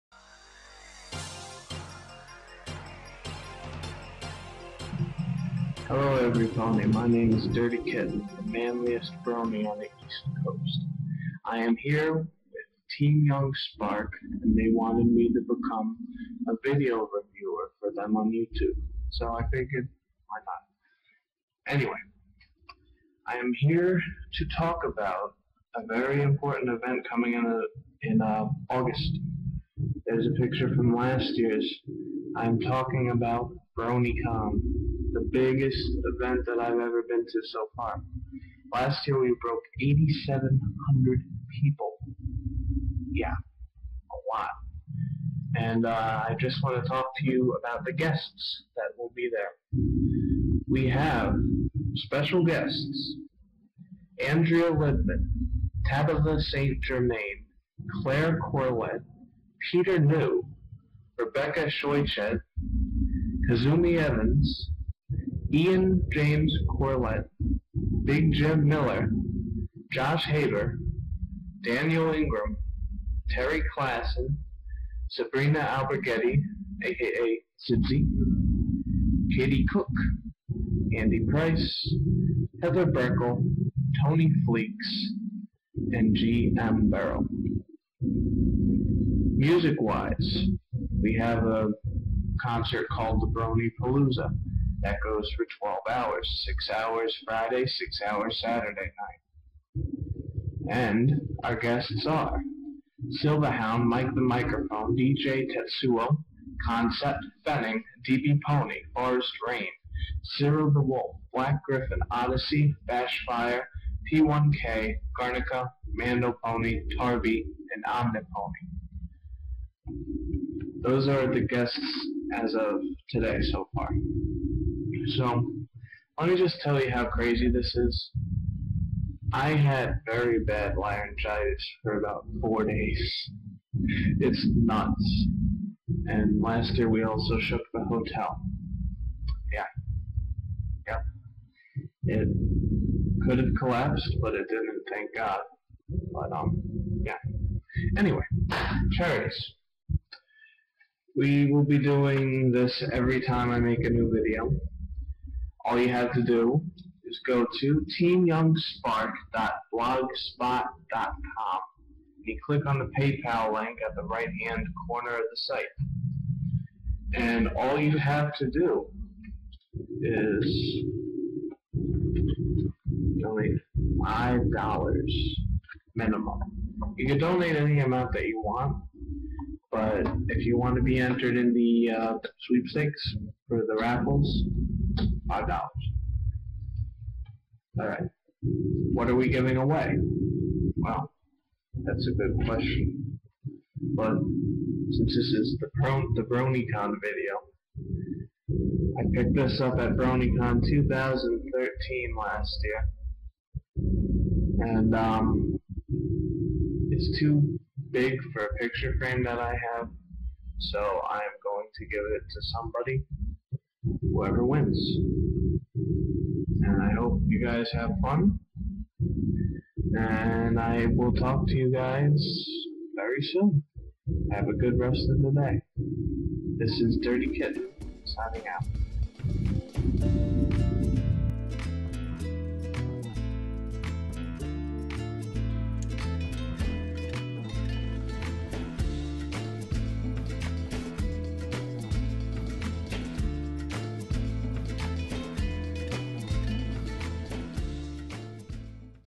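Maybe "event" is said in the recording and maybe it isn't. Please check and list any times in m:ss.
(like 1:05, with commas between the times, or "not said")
0:26, 0:36.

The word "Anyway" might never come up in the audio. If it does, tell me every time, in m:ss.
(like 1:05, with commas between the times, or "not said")
0:21, 2:27.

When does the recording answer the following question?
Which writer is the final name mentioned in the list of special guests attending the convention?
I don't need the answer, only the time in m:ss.
1:26.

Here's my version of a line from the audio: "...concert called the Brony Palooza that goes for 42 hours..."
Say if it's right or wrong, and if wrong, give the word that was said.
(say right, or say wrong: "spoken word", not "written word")
wrong: "12", not "42".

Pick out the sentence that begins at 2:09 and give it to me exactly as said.
I had very bad laryngitis for about four days.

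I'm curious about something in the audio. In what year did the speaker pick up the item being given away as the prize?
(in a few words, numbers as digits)
2013.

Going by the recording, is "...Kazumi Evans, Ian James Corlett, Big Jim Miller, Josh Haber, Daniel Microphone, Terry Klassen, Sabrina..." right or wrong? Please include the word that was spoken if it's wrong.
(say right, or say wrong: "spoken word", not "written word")
wrong: "Ingram", not "Microphone".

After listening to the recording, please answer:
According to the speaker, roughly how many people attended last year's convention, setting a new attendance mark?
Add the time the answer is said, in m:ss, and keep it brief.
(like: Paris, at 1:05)
8,700, at 0:39.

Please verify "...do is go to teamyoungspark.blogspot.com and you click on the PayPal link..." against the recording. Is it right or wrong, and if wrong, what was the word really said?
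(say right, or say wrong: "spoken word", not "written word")
right.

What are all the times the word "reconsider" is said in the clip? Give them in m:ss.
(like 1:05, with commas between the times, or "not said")
not said.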